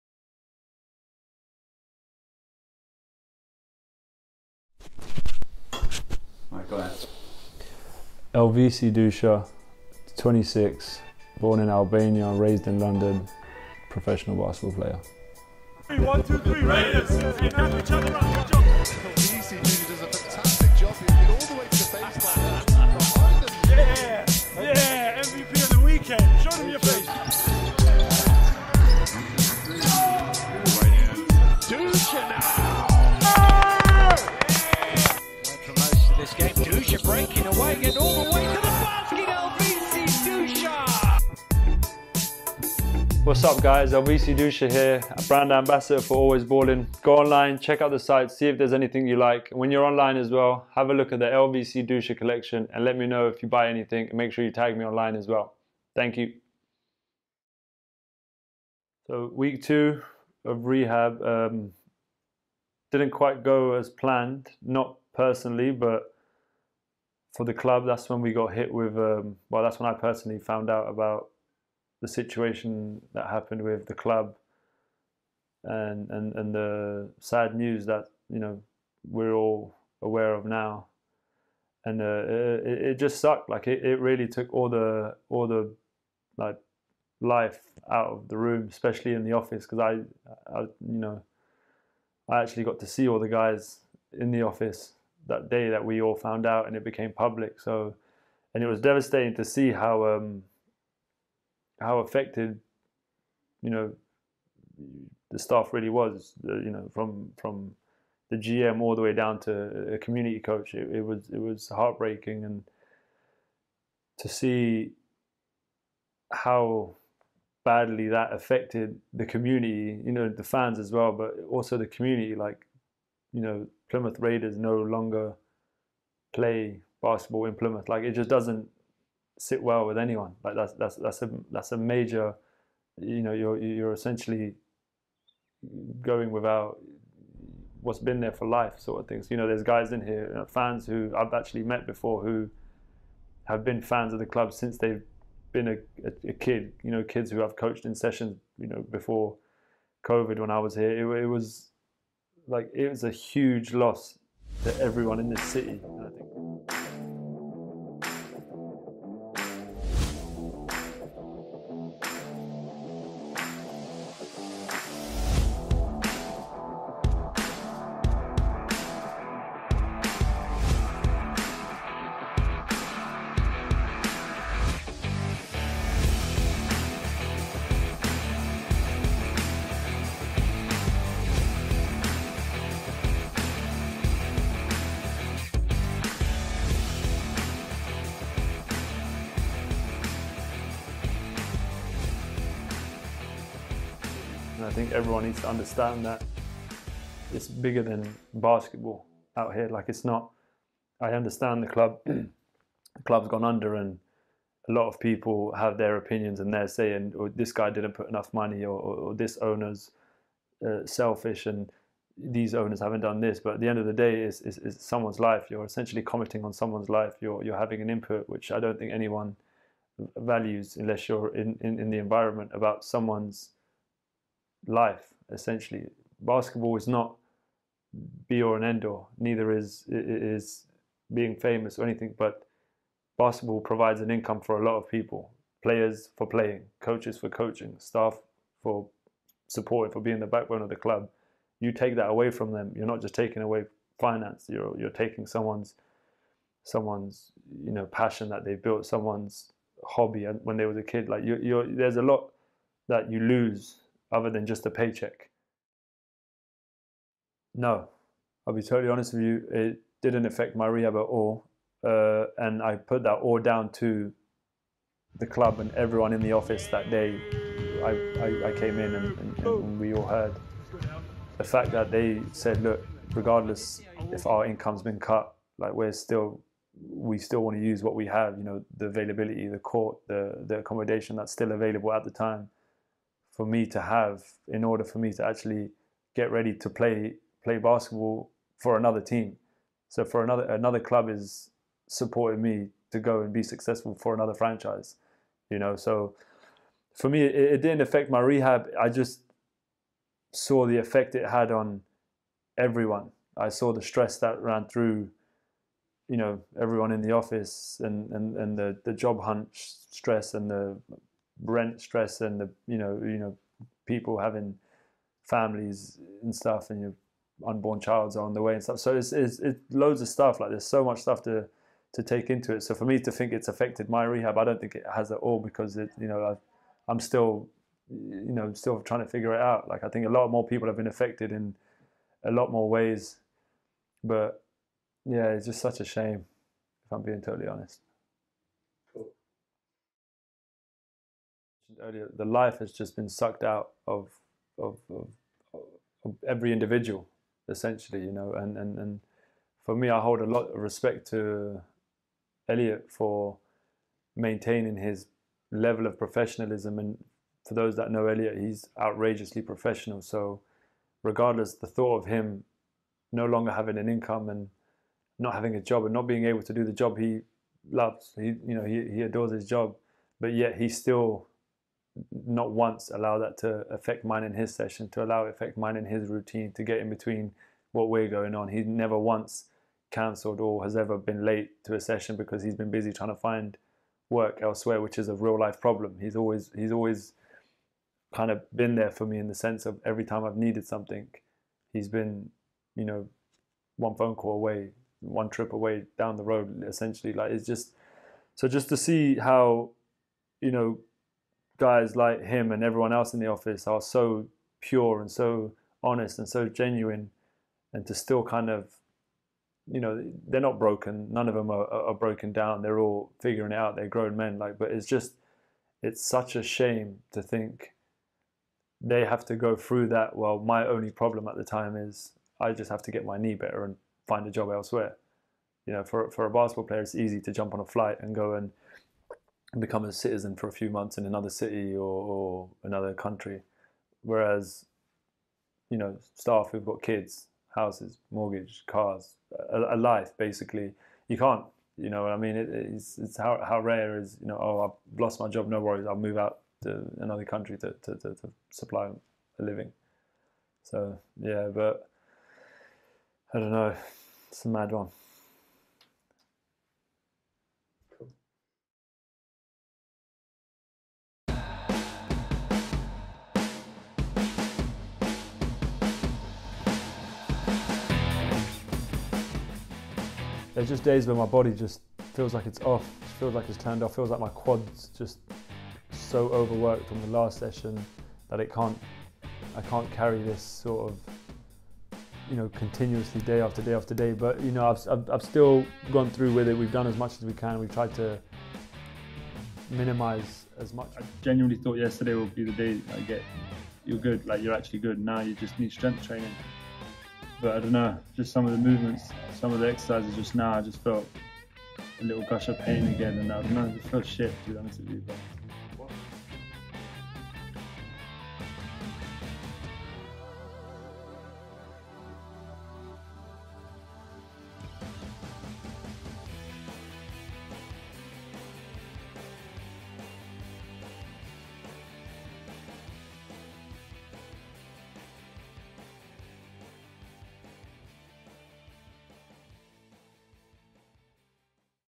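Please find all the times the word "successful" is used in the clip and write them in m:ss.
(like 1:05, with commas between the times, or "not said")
4:53.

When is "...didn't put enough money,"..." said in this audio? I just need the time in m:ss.
3:27.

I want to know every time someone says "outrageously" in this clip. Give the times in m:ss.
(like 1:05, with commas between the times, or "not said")
5:58.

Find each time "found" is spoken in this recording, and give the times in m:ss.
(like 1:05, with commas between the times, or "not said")
1:10, 1:36.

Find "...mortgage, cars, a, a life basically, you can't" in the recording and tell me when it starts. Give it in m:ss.
7:18.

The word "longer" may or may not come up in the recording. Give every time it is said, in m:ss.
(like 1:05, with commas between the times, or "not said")
2:04, 6:03.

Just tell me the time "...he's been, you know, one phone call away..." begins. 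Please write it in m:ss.
6:31.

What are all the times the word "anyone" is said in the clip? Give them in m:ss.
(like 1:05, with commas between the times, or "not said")
2:09, 3:38.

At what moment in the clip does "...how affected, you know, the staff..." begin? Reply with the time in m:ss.
1:41.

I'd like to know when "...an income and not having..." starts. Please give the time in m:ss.
6:03.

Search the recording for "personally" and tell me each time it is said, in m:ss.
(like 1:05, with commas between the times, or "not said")
1:05, 1:09.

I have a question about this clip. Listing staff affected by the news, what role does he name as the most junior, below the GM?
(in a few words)
community coach.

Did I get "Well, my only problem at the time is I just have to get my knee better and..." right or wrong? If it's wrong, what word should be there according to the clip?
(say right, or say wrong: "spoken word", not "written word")
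right.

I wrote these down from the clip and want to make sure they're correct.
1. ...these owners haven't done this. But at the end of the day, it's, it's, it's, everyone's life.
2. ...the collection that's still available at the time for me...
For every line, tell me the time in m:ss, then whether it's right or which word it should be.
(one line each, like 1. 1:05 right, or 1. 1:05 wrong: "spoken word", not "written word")
1. 3:32 wrong: "someone", not "everyone"
2. 4:40 wrong: "accommodation", not "collection".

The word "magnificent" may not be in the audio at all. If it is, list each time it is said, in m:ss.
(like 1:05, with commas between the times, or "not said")
not said.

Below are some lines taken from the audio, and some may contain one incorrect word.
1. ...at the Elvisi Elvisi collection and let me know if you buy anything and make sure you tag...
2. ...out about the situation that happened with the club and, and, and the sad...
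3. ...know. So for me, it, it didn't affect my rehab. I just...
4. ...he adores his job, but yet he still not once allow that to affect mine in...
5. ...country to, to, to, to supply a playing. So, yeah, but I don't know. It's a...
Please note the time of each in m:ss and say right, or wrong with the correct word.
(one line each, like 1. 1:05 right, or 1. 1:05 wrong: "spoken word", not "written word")
1. 0:51 wrong: "Dusha", not "Elvisi"
2. 1:10 right
3. 4:55 right
4. 6:08 right
5. 7:27 wrong: "living", not "playing".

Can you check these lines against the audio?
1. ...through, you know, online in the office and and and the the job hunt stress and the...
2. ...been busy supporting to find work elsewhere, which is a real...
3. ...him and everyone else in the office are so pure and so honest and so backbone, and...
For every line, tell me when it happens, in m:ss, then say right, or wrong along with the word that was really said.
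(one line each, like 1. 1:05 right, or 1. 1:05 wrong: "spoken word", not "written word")
1. 5:04 wrong: "everyone", not "online"
2. 6:22 wrong: "trying", not "supporting"
3. 6:42 wrong: "genuine", not "backbone".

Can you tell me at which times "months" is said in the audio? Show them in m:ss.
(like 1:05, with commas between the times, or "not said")
7:10.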